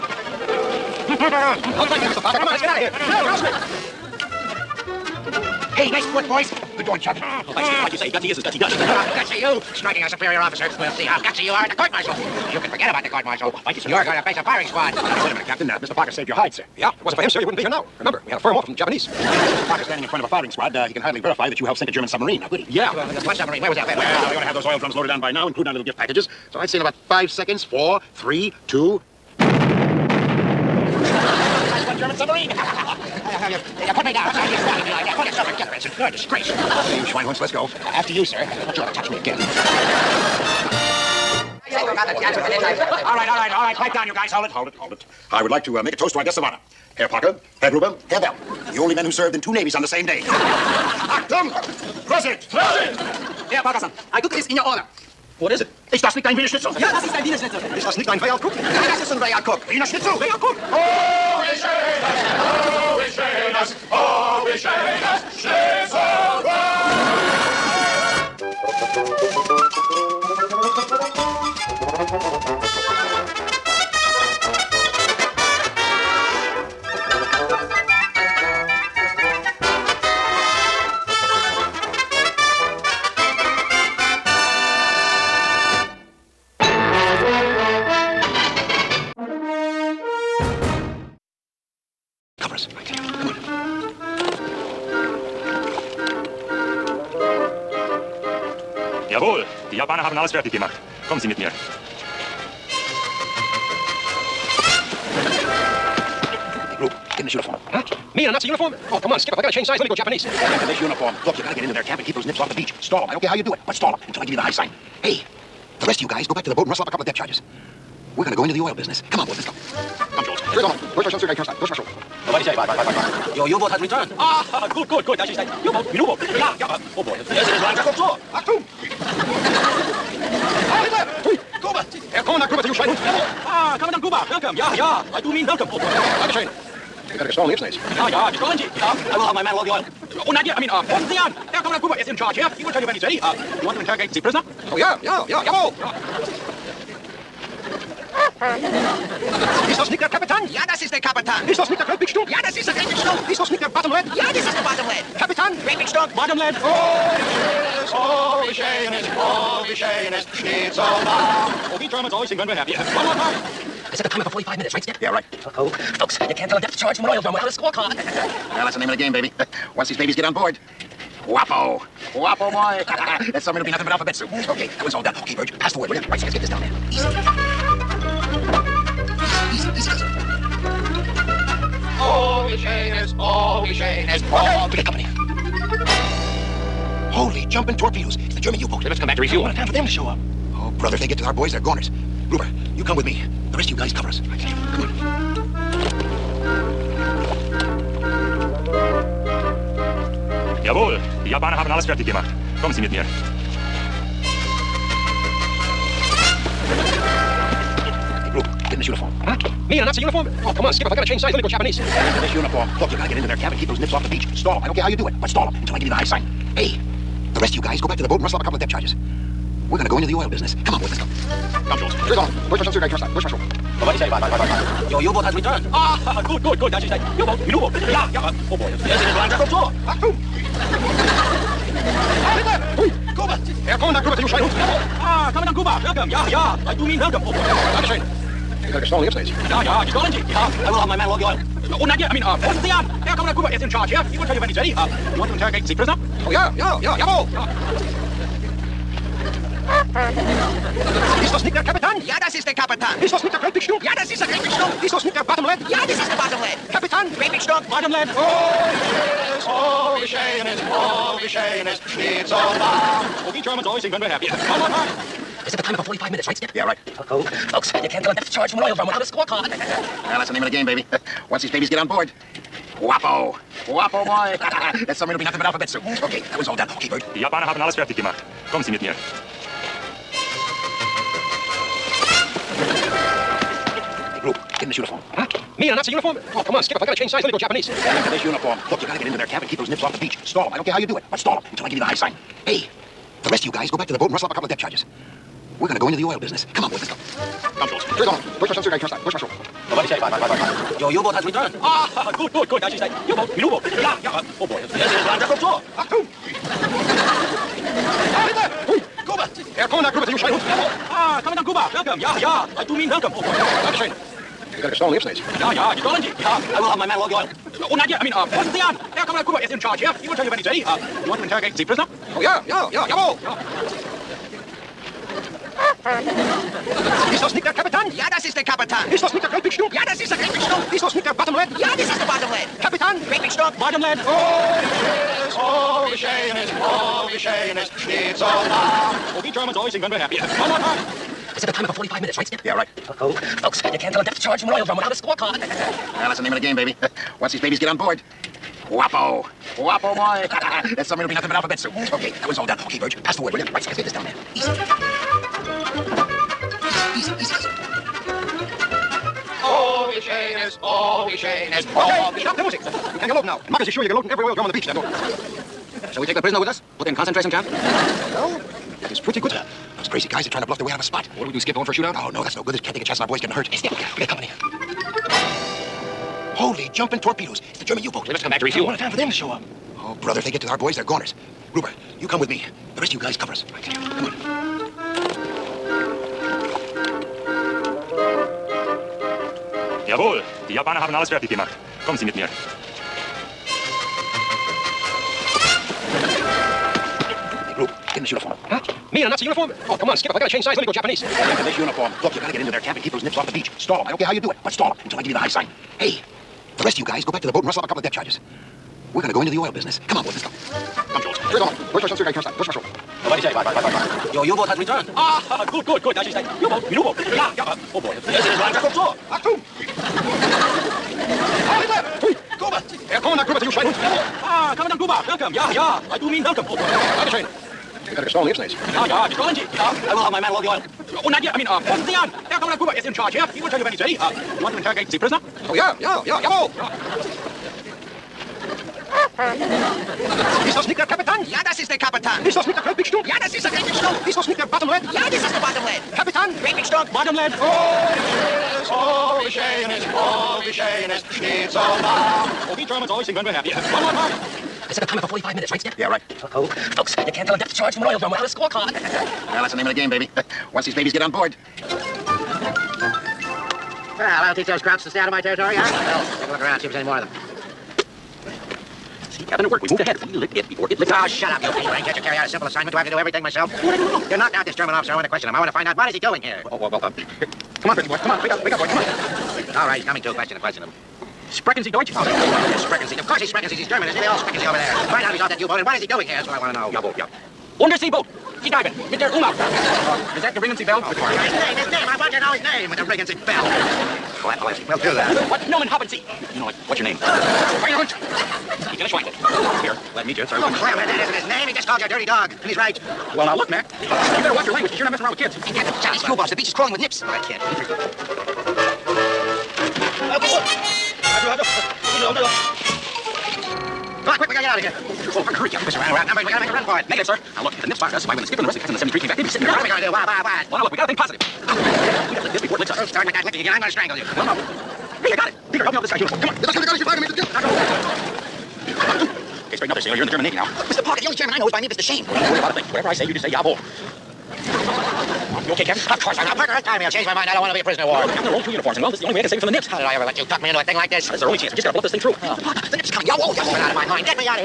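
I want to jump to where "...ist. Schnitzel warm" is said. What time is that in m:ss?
7:30.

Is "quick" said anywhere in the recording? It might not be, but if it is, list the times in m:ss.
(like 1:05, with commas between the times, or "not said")
8:34.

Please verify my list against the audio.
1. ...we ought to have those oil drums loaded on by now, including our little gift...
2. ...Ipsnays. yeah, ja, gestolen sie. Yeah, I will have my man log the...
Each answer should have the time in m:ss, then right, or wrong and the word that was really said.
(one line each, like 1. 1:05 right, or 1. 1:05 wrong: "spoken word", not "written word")
1. 0:24 right
2. 5:14 right.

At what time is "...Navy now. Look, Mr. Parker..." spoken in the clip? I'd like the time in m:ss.
8:50.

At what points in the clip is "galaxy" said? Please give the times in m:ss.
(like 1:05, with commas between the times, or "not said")
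not said.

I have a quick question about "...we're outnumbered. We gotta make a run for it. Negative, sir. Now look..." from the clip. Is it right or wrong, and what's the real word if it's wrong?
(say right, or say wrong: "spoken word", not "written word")
right.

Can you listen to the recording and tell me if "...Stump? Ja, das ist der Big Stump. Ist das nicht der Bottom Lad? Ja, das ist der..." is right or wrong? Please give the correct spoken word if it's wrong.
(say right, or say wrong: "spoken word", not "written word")
right.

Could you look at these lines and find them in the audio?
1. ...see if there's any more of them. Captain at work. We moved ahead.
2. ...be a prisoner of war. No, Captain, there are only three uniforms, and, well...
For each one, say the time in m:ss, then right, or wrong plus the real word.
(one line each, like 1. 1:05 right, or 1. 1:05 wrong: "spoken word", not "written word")
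1. 7:46 right
2. 8:57 wrong: "two", not "three".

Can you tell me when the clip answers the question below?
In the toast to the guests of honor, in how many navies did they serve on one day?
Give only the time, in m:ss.
0:49.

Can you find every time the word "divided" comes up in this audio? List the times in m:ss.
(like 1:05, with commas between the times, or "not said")
not said.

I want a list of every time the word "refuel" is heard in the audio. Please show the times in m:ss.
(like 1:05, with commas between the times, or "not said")
3:09, 6:18.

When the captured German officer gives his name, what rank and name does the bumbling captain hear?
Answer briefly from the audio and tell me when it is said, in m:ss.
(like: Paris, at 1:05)
Lieutenant Schweinehund, at 8:18.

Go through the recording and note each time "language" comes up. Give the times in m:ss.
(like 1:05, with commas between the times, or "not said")
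8:24.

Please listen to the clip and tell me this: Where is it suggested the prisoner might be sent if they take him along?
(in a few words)
Concentration camp.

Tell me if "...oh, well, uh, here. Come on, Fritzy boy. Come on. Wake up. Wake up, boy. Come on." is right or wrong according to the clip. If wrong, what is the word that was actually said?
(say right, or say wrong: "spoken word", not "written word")
right.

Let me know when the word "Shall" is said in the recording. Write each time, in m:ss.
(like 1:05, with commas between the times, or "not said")
6:05.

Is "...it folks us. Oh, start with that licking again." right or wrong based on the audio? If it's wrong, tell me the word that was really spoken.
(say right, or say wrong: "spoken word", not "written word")
wrong: "licks", not "folks".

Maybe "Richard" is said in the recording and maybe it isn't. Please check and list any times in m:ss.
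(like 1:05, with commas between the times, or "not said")
not said.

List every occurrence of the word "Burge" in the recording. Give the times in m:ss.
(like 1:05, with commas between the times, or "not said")
2:55, 5:52.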